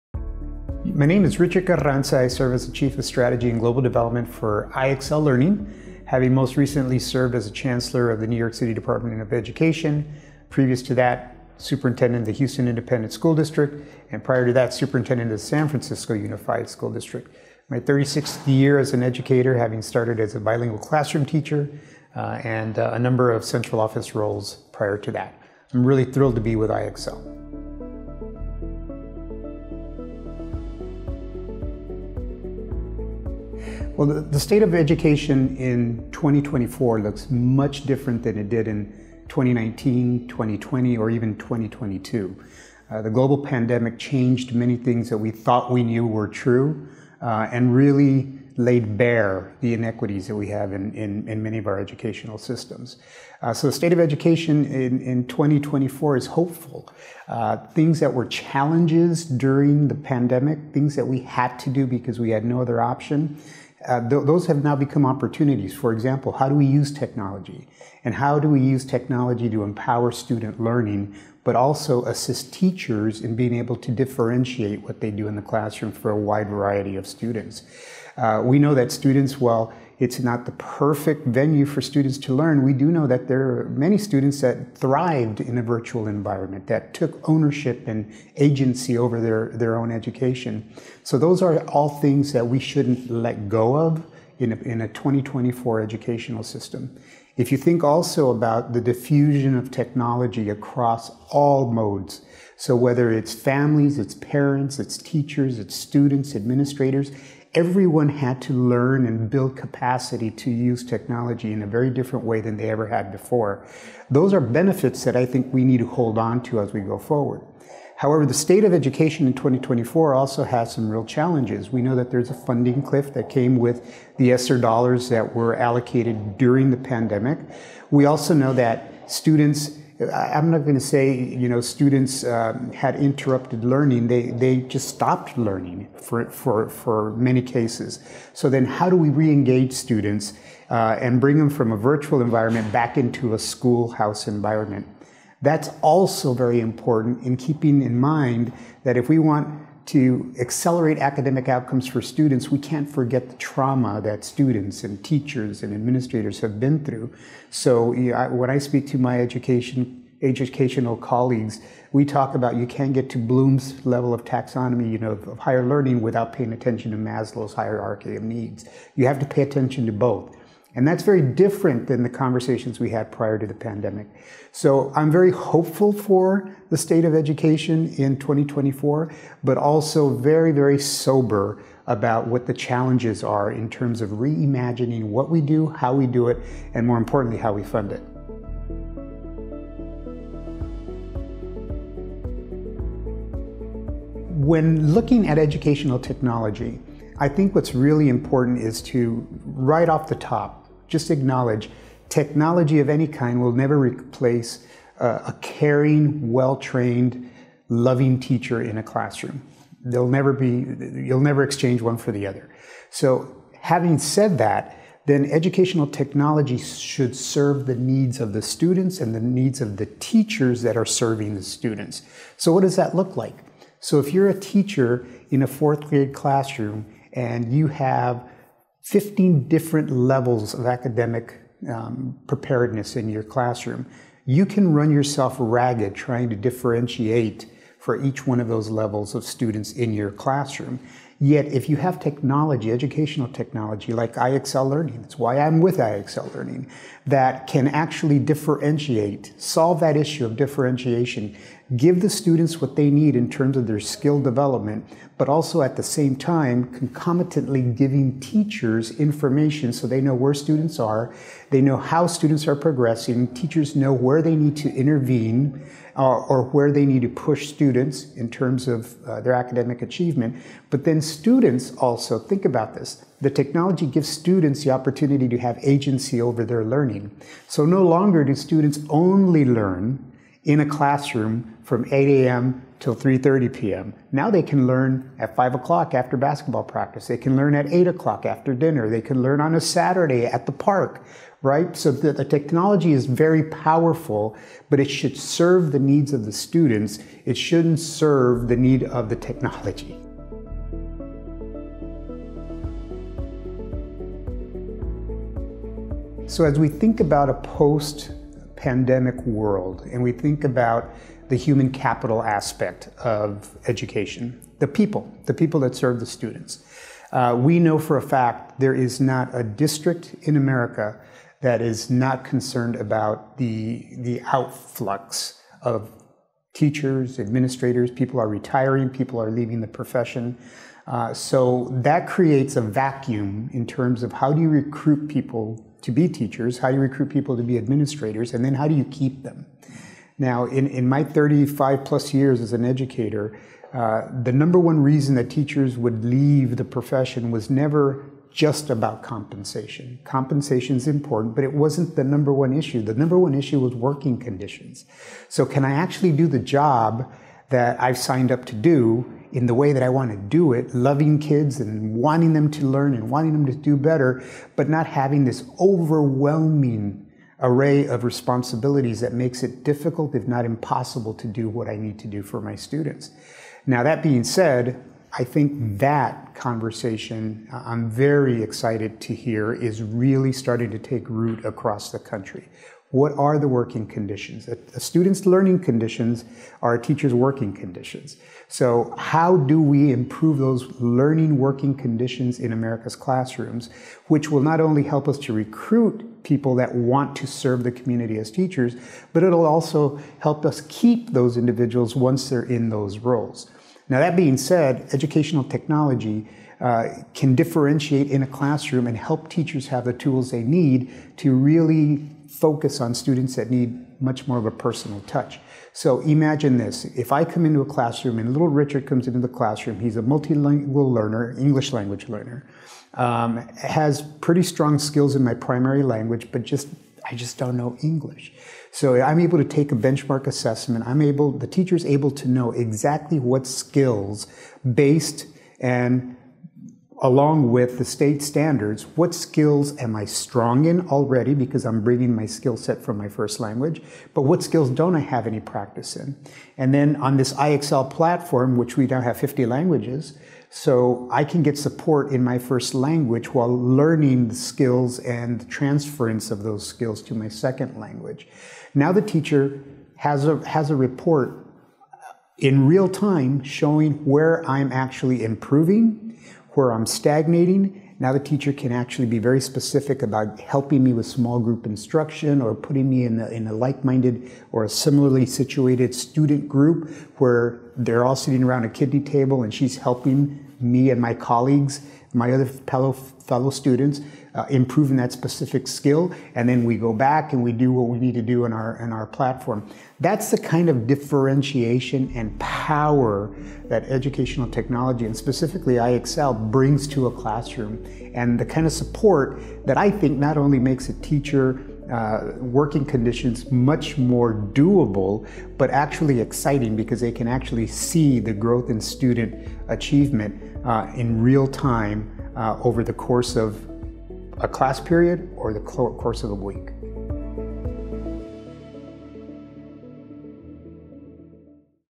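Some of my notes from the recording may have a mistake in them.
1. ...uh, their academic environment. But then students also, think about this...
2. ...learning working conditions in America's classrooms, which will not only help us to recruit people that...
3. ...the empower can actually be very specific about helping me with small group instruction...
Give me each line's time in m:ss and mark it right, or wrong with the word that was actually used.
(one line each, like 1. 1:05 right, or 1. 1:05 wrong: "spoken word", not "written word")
1. 4:29 wrong: "achievement", not "environment"
2. 6:30 right
3. 7:48 wrong: "teacher", not "empower".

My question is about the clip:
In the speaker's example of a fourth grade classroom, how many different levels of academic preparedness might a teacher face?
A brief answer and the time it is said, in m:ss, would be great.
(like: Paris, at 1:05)
15, at 3:48.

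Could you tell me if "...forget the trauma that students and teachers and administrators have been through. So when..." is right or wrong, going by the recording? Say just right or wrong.
right.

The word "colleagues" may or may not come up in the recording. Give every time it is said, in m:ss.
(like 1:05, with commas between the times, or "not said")
2:40, 8:01.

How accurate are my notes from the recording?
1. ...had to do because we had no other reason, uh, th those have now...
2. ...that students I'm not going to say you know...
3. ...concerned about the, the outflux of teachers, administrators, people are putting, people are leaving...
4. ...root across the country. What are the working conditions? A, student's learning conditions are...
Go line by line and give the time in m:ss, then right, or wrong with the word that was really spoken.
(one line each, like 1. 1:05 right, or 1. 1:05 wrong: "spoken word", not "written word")
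1. 1:01 wrong: "option", not "reason"
2. 2:08 right
3. 5:22 wrong: "retiring", not "putting"
4. 6:21 right.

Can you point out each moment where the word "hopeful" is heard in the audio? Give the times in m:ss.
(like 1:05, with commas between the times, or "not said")
0:56, 2:55.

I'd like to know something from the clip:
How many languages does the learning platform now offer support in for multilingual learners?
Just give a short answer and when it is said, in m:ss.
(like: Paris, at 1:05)
50, at 7:29.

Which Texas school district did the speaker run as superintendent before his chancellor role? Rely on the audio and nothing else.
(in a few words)
Houston Independent School District.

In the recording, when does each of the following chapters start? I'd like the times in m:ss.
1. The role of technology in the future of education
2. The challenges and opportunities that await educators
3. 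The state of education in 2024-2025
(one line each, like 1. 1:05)
1. 3:09
2. 5:01
3. 0:28.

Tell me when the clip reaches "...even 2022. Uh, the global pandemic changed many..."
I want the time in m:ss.
0:41.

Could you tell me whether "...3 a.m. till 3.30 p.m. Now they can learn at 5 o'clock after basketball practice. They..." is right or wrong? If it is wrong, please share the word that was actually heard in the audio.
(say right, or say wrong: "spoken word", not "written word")
wrong: "8", not "3".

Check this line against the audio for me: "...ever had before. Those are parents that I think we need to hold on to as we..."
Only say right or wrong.
wrong.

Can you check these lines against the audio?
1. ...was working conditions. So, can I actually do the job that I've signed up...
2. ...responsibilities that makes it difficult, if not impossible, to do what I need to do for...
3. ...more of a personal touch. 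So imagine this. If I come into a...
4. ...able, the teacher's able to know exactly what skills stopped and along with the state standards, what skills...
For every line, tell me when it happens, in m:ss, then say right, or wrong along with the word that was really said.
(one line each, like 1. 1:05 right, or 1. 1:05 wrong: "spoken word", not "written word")
1. 5:53 right
2. 6:08 right
3. 6:54 right
4. 7:11 wrong: "based", not "stopped".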